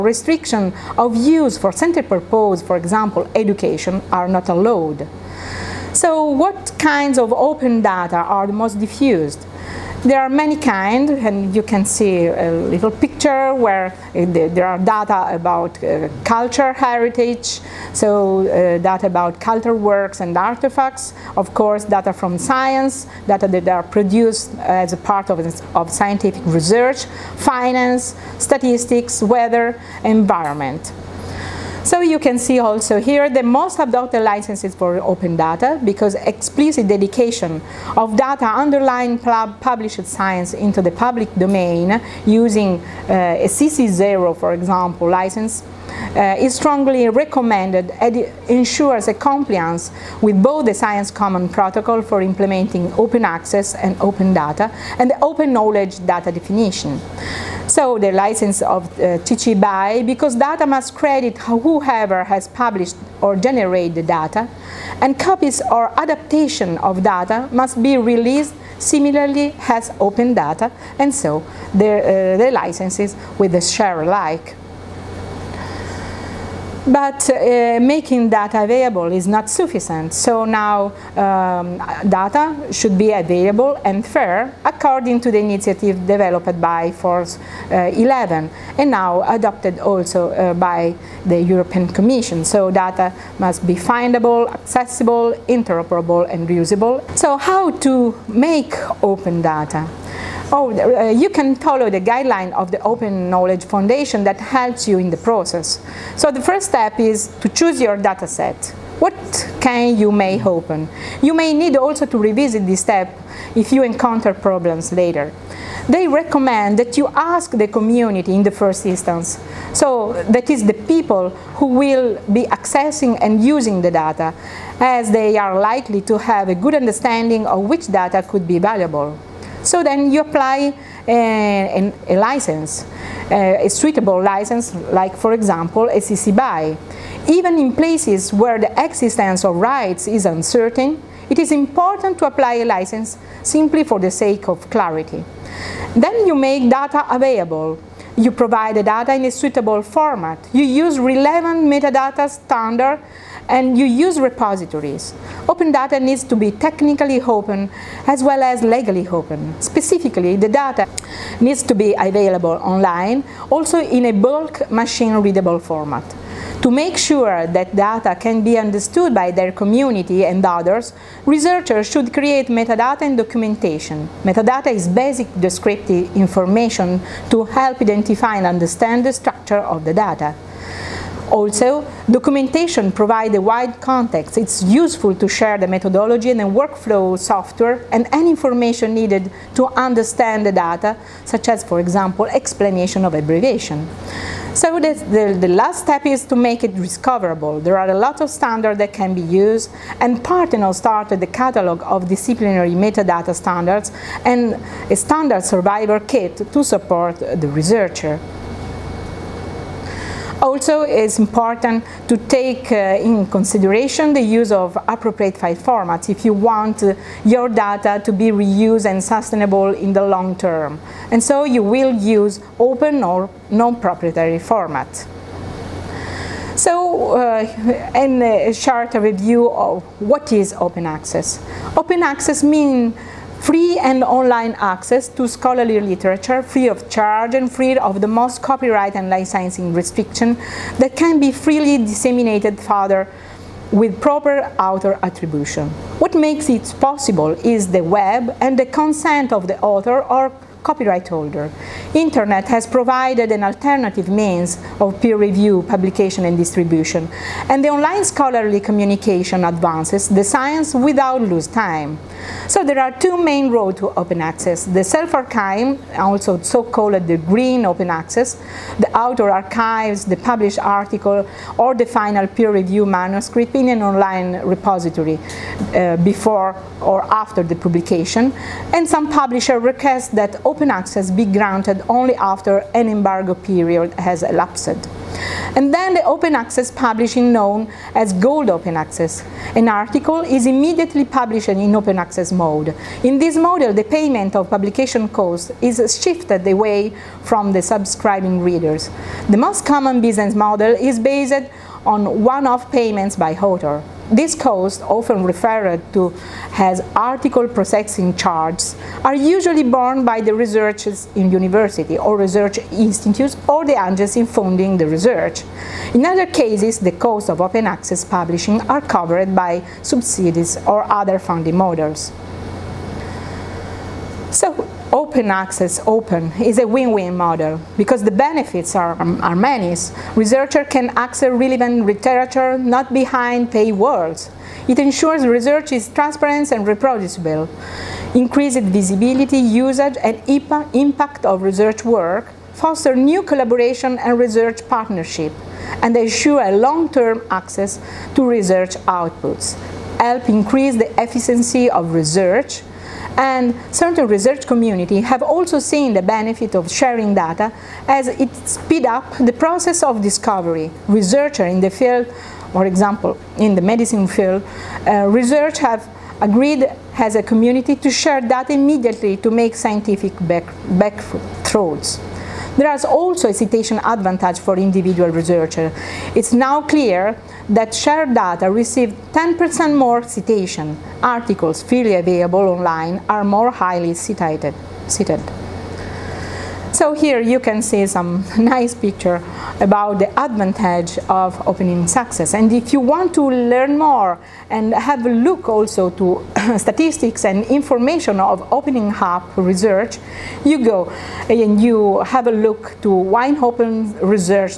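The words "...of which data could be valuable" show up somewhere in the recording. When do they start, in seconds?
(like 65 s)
127 s.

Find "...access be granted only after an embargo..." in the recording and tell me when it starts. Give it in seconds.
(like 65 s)
280 s.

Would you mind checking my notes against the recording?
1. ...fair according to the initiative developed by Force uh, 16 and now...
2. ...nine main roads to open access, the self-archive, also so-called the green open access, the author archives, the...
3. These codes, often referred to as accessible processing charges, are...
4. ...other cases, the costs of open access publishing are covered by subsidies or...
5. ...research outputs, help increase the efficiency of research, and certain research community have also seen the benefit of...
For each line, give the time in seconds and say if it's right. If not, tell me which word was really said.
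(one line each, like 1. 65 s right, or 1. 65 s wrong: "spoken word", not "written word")
1. 84 s wrong: "11", not "16"
2. 262 s wrong: "two", not "nine"
3. 304 s wrong: "article", not "accessible"
4. 316 s right
5. 348 s right.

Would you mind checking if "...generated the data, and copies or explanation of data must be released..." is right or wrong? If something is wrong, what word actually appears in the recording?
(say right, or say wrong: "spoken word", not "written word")
wrong: "adaptation", not "explanation".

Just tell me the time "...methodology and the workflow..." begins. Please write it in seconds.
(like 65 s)
185 s.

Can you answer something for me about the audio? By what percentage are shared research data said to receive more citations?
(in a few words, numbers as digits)
10%.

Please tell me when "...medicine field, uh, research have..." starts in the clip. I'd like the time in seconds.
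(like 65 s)
363 s.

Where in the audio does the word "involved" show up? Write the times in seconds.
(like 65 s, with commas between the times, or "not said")
not said.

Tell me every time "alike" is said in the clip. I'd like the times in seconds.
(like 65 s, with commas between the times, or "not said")
74 s.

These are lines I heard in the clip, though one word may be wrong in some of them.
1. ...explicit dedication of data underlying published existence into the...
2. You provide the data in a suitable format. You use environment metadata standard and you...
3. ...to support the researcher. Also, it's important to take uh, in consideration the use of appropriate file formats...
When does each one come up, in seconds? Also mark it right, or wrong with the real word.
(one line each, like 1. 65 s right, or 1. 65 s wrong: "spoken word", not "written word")
1. 36 s wrong: "science", not "existence"
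2. 148 s wrong: "relevant", not "environment"
3. 206 s right.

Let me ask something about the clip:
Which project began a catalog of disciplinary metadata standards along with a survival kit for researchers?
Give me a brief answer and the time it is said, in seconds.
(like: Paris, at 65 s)
Parthenos, at 200 s.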